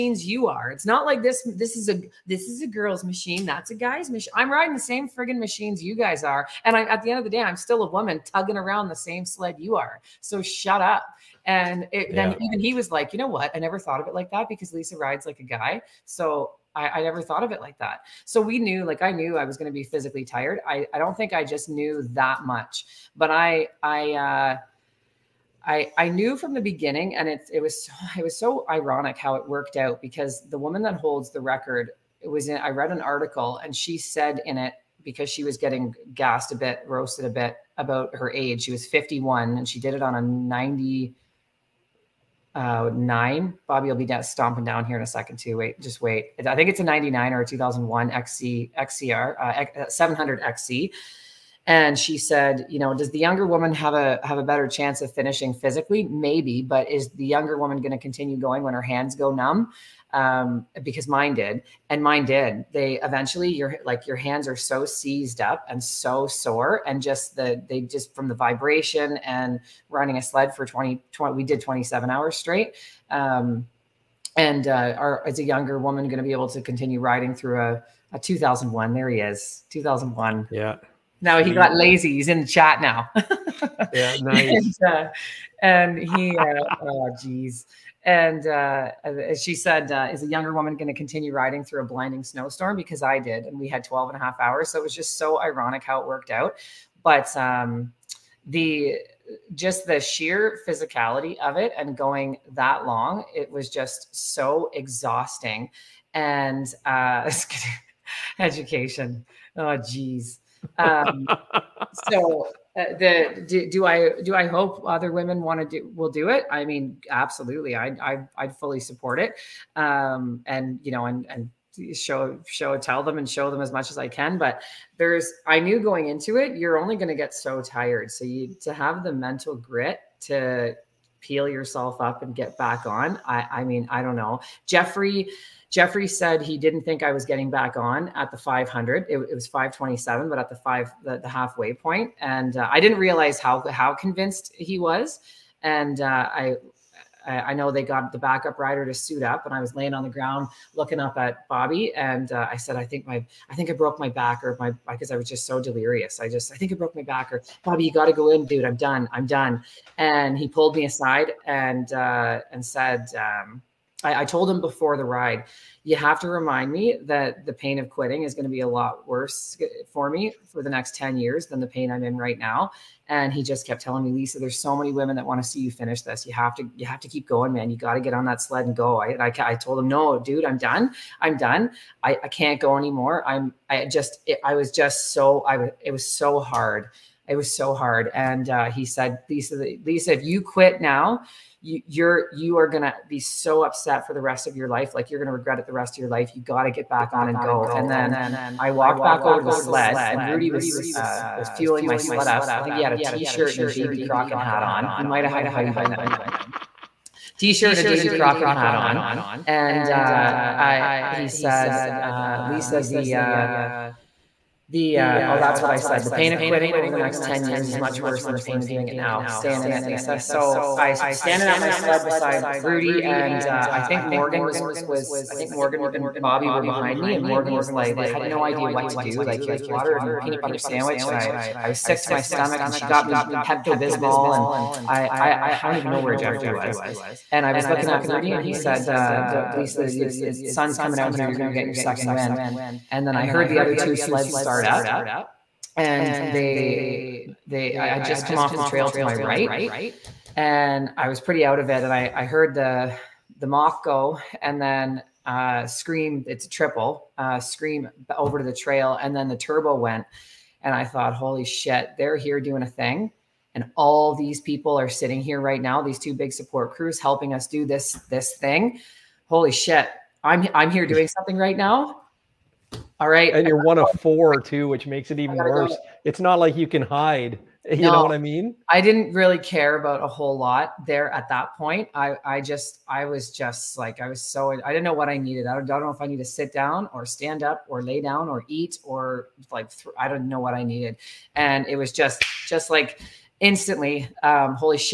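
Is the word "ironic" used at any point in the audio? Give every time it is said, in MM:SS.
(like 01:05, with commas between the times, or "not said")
00:28, 01:35.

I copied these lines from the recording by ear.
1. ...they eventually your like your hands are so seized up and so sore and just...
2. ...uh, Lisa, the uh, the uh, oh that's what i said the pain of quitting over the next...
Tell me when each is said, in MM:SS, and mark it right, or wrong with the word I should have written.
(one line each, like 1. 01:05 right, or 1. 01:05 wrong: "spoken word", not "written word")
1. 01:02 right
2. 03:32 right.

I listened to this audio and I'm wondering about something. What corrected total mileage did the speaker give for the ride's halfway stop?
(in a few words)
527.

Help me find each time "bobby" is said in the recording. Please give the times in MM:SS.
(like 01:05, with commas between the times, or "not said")
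00:43, 02:31, 02:37, 03:46.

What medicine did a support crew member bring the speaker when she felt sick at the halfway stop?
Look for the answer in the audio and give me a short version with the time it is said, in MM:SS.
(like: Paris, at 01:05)
Pepto-Bismol, at 03:53.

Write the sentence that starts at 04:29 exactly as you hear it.
Holy shit, I'm I'm here doing something right now all right.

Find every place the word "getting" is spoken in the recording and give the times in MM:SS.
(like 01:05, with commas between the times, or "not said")
00:35, 02:17.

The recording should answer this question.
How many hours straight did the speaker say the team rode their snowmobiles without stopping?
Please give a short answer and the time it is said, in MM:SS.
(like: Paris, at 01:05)
27, at 01:11.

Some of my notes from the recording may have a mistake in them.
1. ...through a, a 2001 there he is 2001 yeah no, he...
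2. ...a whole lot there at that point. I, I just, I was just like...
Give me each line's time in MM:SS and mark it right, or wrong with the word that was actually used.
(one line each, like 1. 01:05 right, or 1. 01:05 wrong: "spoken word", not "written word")
1. 01:17 right
2. 04:40 right.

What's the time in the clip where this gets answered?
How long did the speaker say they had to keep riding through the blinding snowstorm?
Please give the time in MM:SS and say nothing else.
01:33.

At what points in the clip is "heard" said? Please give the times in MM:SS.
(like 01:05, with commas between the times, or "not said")
04:03, 04:12.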